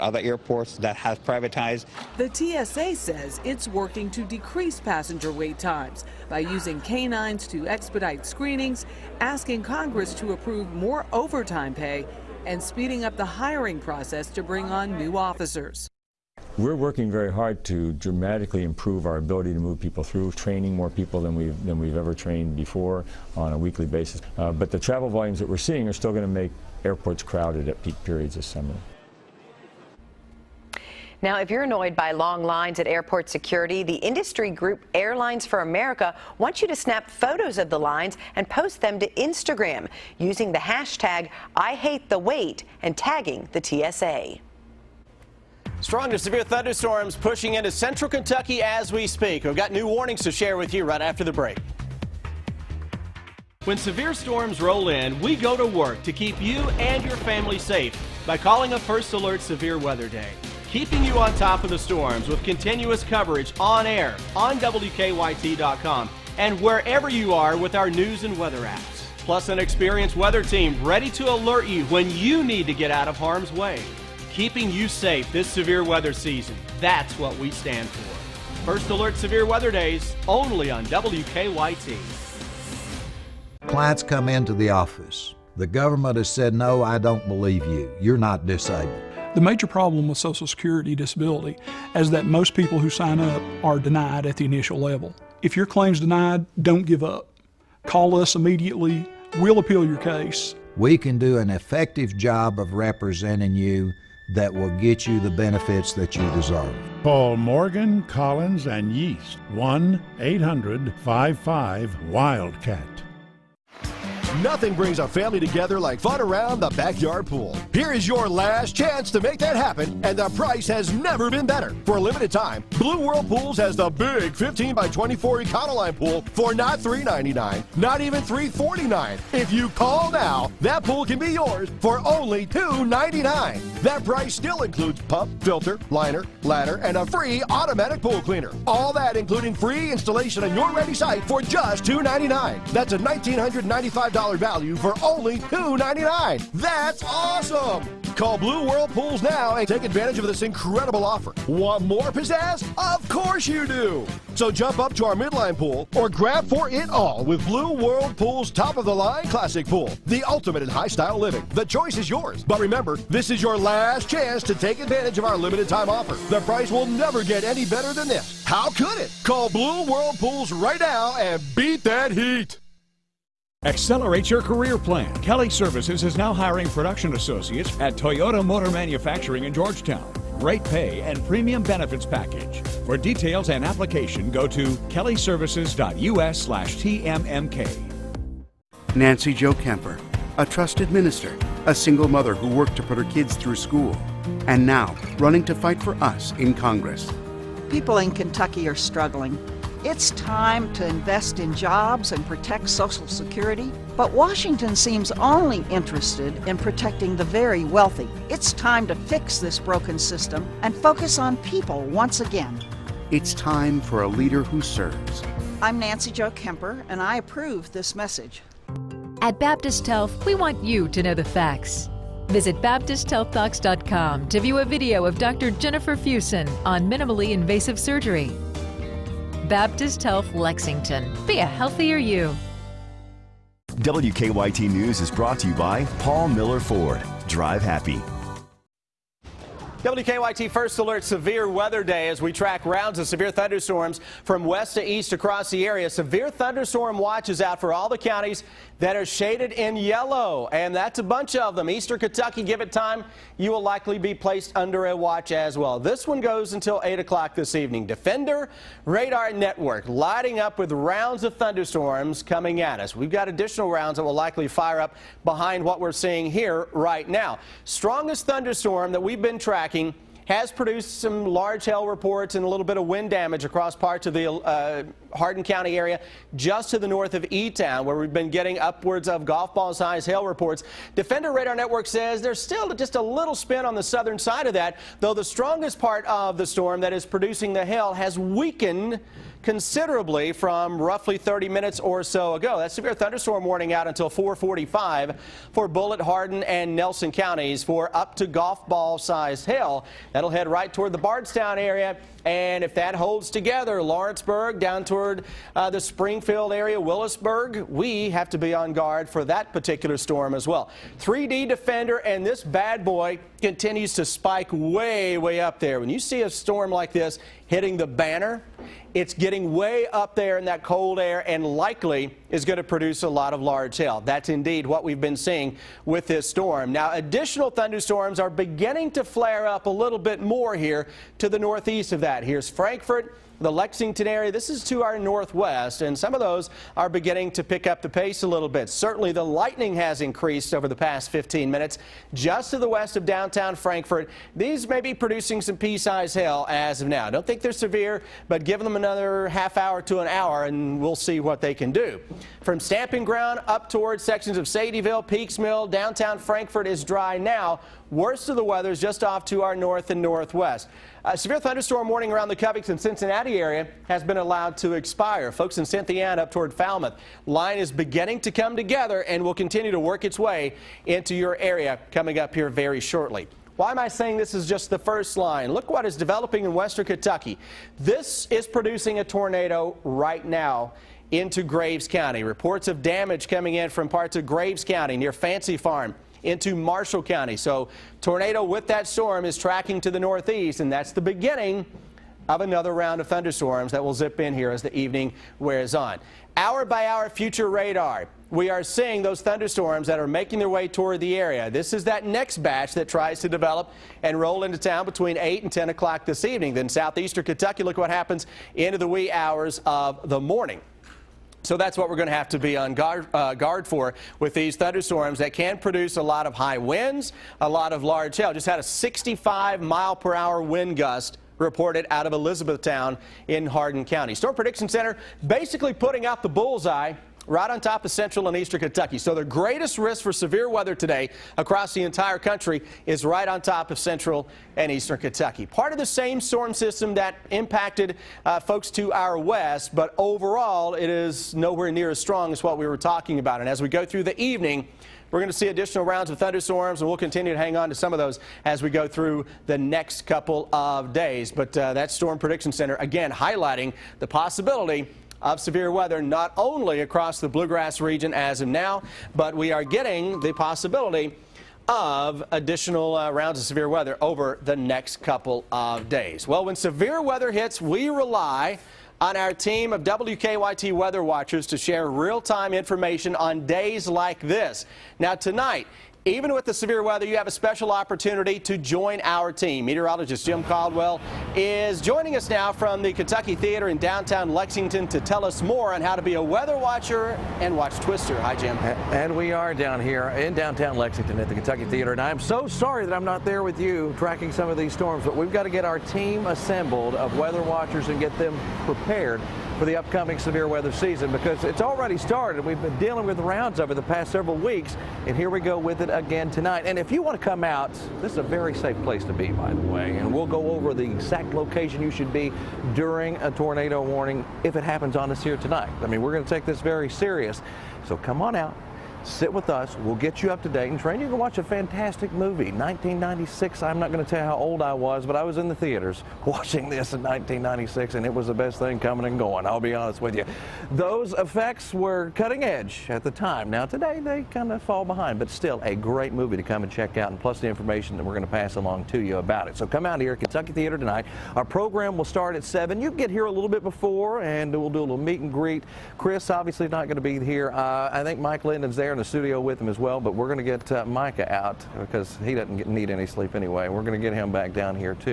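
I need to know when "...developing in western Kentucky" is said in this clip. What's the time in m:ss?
6:15.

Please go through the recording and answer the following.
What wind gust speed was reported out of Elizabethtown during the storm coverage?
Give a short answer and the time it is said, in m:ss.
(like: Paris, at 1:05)
65 mph, at 6:58.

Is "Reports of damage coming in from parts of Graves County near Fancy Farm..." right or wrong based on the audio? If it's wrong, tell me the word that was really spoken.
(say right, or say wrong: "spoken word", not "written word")
right.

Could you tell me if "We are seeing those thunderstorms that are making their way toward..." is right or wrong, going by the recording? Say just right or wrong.
right.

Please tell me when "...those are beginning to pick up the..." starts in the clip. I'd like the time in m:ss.
5:36.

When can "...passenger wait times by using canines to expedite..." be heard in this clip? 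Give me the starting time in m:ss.
0:04.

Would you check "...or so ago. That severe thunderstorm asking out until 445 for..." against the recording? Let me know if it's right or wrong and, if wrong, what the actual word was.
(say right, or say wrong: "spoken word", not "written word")
wrong: "warning", not "asking".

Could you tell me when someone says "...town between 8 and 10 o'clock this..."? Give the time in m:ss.
6:44.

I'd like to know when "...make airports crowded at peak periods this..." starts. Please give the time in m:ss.
0:26.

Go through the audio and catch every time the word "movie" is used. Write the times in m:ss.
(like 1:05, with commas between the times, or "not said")
8:42, 8:56.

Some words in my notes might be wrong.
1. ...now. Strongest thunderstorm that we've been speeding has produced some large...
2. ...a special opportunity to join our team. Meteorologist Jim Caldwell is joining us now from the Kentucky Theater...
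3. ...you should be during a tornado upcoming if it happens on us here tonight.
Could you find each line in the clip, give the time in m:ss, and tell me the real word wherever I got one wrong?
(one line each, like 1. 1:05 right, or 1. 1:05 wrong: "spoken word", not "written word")
1. 4:27 wrong: "tracking", not "speeding"
2. 7:57 right
3. 8:31 wrong: "warning", not "upcoming".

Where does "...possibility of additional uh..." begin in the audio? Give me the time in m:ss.
7:40.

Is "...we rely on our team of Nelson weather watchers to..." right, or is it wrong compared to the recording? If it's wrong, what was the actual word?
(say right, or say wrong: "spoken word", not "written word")
wrong: "WKYT", not "Nelson".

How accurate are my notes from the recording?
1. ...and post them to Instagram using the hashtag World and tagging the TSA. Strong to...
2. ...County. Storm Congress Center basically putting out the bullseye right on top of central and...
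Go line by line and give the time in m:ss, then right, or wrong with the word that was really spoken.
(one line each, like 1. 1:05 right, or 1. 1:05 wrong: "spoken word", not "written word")
1. 0:38 wrong: "IHateTheWait", not "World"
2. 7:03 wrong: "Prediction", not "Congress".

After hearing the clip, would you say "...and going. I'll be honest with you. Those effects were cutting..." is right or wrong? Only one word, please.
right.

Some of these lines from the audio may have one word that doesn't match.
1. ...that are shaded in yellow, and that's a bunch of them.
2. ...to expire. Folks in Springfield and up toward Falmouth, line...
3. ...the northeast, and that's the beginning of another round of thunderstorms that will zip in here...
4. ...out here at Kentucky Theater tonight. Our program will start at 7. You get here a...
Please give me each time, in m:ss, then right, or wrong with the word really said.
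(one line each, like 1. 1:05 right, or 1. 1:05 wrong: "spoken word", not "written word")
1. 4:08 right
2. 6:04 wrong: "Cynthiana", not "Springfield"
3. 6:29 right
4. 8:59 right.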